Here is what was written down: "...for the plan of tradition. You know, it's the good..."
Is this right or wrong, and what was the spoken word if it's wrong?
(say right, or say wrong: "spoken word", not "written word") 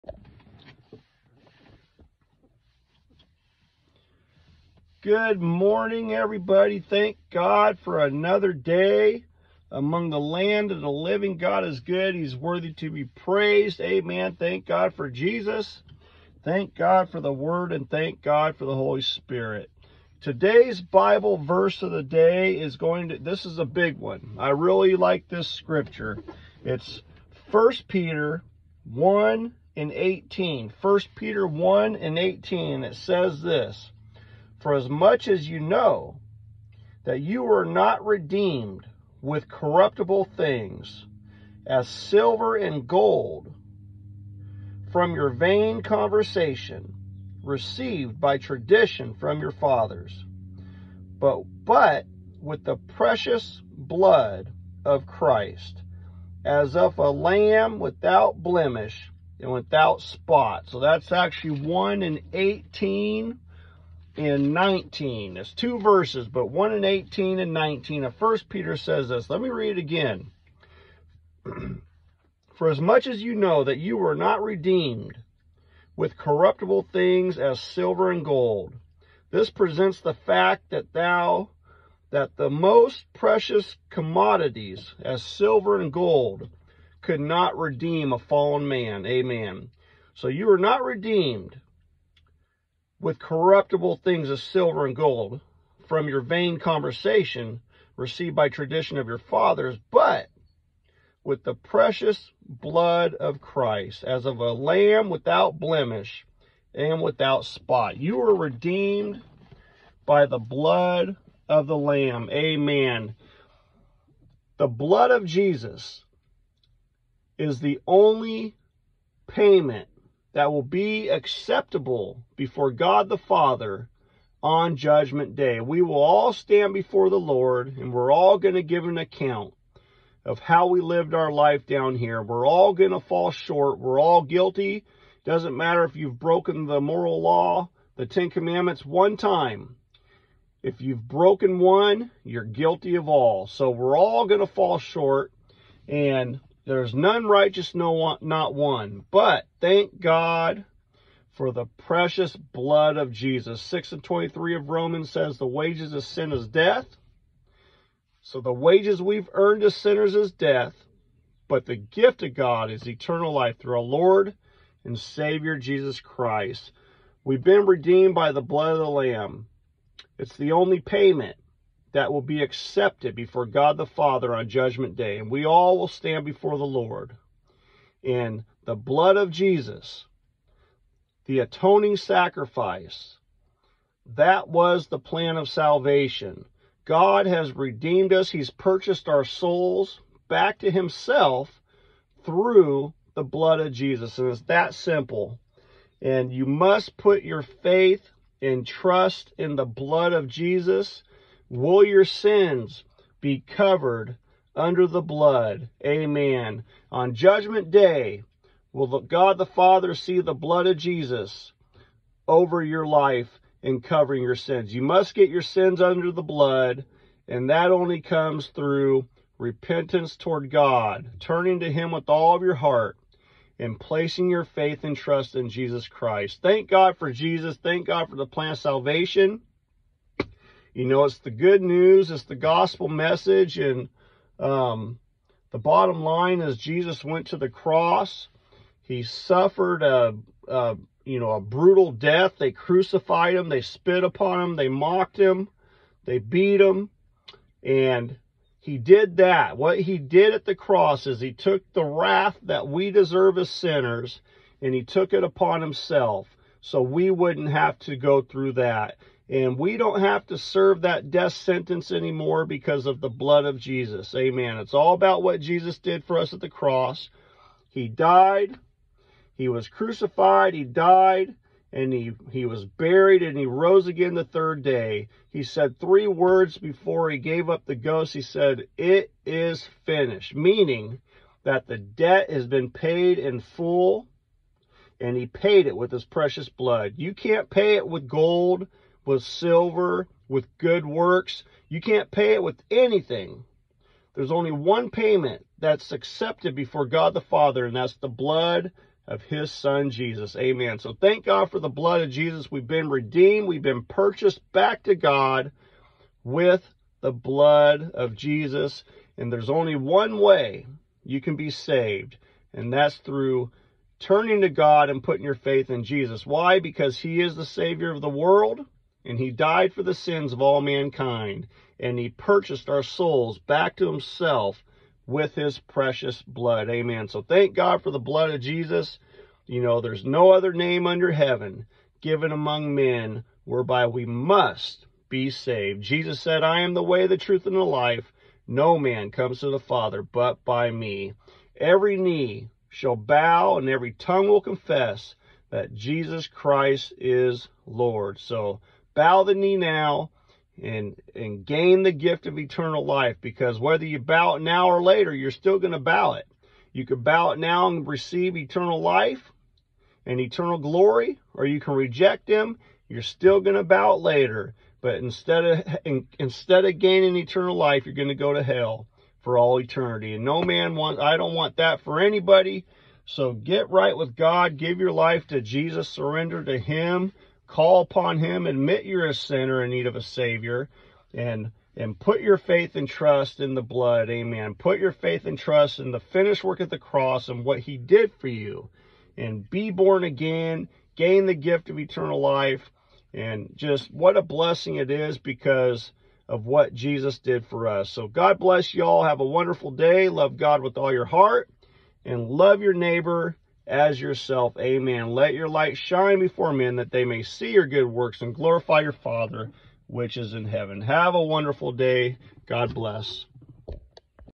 wrong: "salvation", not "tradition".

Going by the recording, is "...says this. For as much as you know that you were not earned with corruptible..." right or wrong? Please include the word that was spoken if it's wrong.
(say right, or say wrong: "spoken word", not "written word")
wrong: "redeemed", not "earned".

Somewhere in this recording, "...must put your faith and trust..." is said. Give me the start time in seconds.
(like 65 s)
196 s.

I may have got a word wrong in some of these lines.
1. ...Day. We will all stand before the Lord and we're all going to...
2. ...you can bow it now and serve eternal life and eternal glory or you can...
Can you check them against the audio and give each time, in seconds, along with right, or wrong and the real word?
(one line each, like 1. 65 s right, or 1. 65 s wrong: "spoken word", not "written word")
1. 125 s right
2. 356 s wrong: "receive", not "serve".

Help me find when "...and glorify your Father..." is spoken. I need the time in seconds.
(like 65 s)
408 s.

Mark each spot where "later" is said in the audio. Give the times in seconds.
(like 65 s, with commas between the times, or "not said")
354 s, 364 s.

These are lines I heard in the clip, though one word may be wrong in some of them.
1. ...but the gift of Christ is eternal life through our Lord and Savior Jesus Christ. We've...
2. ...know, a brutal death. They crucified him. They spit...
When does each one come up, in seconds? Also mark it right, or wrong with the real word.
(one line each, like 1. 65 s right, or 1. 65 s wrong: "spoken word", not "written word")
1. 161 s wrong: "God", not "Christ"
2. 241 s right.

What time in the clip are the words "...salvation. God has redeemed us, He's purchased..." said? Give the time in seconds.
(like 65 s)
185 s.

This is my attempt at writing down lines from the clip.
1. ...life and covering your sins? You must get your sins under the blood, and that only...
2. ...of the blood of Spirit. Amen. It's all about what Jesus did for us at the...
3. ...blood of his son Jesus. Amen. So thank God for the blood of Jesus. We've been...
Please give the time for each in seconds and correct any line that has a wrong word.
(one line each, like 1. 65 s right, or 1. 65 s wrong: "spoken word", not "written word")
1. 212 s right
2. 262 s wrong: "Jesus", not "Spirit"
3. 298 s right.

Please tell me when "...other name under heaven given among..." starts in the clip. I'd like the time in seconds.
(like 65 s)
330 s.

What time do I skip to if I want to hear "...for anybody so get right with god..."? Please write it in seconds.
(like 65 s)
371 s.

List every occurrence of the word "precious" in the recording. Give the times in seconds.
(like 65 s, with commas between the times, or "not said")
52 s, 83 s, 101 s, 151 s, 286 s, 325 s.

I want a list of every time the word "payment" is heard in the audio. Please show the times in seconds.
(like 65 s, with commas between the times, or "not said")
119 s, 170 s, 294 s.